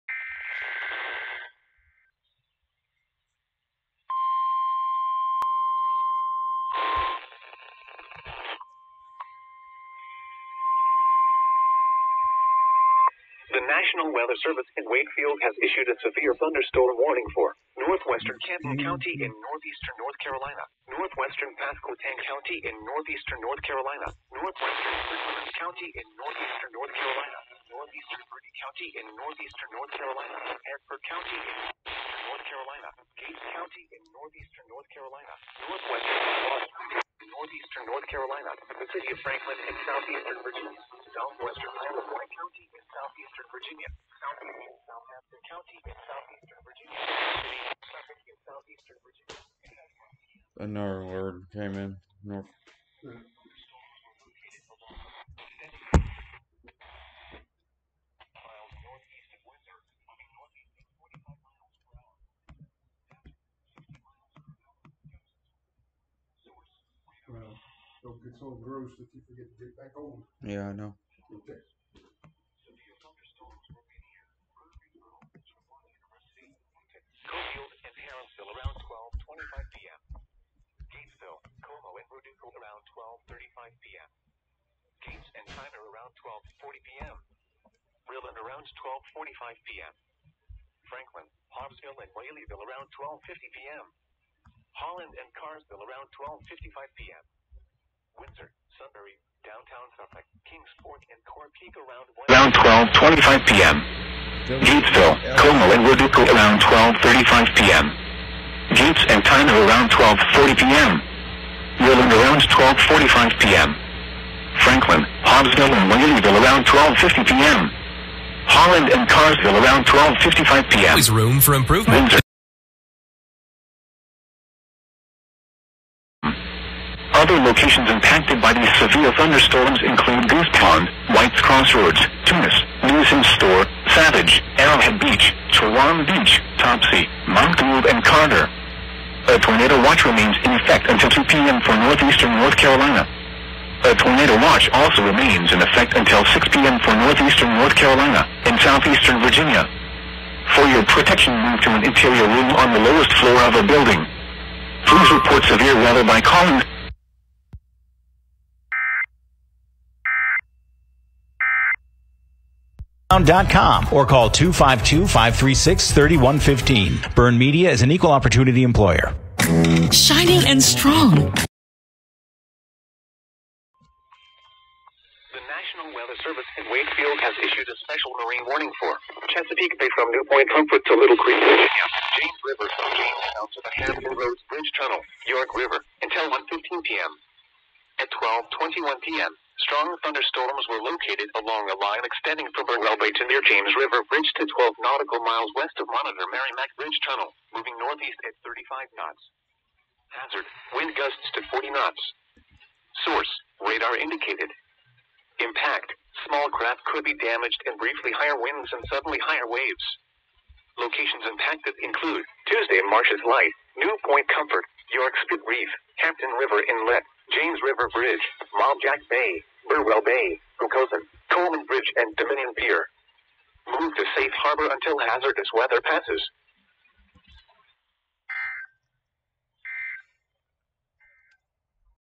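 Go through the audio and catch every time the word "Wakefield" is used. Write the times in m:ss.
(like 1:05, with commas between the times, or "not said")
0:14, 2:56.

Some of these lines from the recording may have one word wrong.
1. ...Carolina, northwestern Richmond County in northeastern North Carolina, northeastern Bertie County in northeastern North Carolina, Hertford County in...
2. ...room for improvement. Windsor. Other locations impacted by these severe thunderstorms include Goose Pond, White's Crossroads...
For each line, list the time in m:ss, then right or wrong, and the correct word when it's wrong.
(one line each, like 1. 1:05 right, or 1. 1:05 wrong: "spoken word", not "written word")
1. 0:23 right
2. 2:01 right.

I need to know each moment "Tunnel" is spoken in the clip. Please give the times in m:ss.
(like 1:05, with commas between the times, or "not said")
3:04, 3:17.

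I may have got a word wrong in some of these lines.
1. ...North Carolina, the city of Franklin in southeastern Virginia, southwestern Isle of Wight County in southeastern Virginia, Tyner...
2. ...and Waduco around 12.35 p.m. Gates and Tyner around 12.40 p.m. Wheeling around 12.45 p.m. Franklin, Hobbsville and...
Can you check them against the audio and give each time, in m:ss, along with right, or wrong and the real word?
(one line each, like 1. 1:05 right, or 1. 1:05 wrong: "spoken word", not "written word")
1. 0:37 wrong: "Southampton", not "Tyner"
2. 1:45 right.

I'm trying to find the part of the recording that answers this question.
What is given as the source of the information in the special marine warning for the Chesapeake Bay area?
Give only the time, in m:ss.
3:23.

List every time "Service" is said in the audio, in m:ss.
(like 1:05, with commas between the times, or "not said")
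0:14, 2:56.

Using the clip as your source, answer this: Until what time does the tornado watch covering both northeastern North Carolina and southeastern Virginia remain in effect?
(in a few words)
6 p.m.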